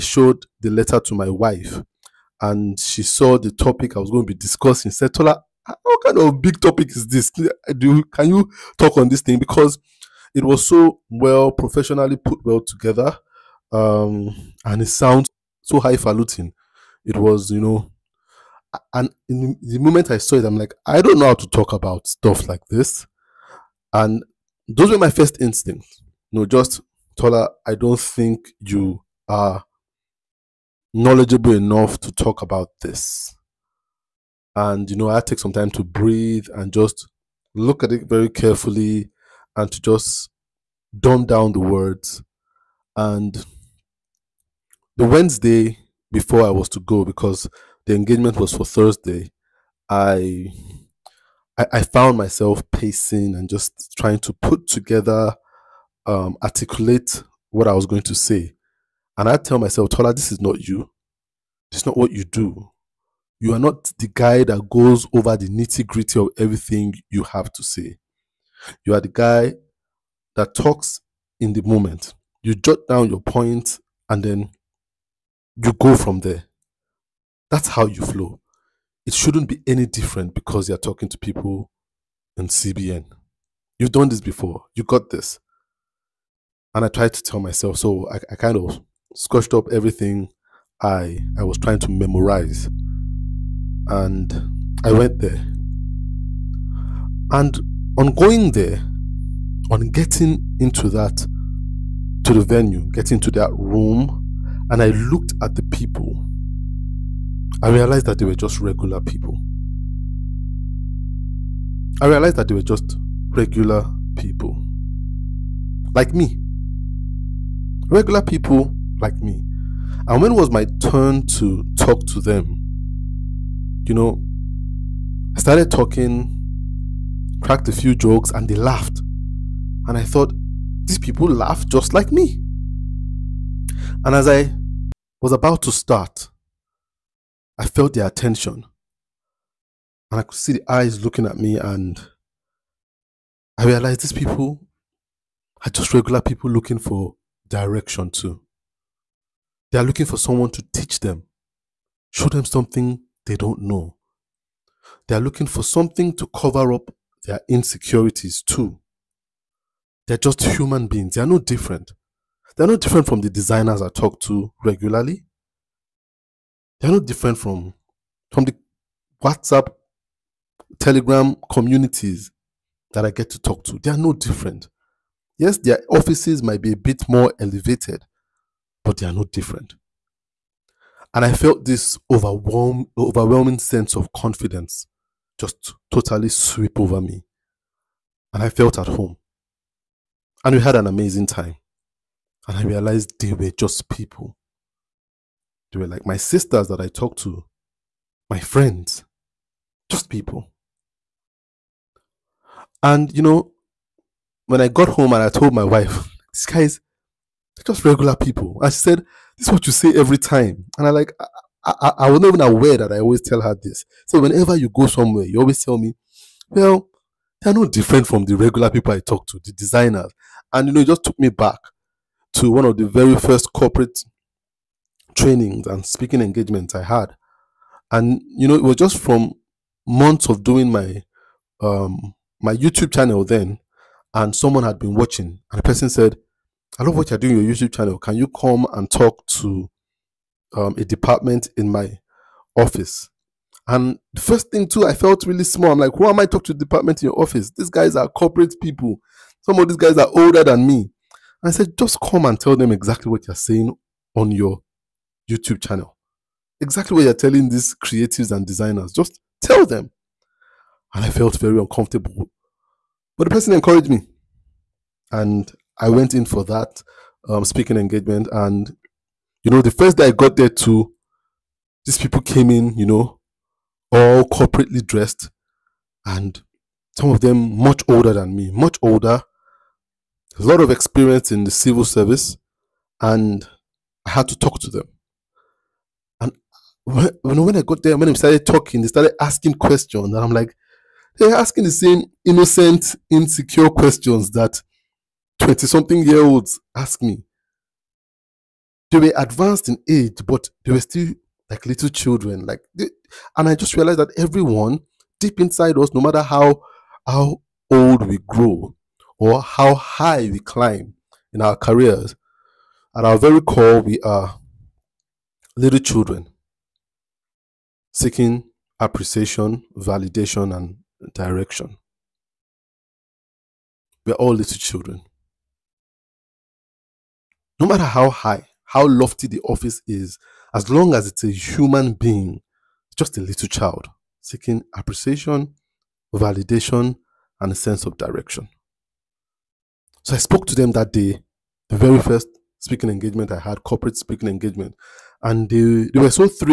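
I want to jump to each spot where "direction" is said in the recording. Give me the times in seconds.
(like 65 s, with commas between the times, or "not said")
147 s, 321 s, 337 s.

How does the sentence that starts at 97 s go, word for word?
And on going there, on getting into that to the venue, getting to that room, and I looked at the people.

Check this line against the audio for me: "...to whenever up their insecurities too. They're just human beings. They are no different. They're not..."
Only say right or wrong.
wrong.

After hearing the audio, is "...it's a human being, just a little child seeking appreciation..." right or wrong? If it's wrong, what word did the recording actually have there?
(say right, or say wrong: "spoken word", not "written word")
right.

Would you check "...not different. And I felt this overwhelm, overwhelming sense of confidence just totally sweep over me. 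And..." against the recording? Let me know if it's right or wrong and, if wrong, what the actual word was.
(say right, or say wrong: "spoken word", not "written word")
right.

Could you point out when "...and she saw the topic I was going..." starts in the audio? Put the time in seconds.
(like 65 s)
2 s.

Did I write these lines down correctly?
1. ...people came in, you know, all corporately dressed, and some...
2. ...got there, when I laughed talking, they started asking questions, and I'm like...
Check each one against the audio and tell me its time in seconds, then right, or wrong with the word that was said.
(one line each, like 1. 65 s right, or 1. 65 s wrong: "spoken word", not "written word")
1. 271 s right
2. 287 s wrong: "started", not "laughed".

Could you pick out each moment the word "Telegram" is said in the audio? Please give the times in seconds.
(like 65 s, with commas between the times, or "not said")
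170 s.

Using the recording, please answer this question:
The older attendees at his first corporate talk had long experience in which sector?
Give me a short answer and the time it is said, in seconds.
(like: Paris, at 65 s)
civil service, at 281 s.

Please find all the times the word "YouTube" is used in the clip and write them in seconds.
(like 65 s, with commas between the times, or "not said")
232 s, 237 s, 255 s.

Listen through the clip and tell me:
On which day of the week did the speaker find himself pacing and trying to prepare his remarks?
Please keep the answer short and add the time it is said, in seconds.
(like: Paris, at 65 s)
Wednesday, at 45 s.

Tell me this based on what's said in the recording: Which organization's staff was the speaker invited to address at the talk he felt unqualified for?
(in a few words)
CBN.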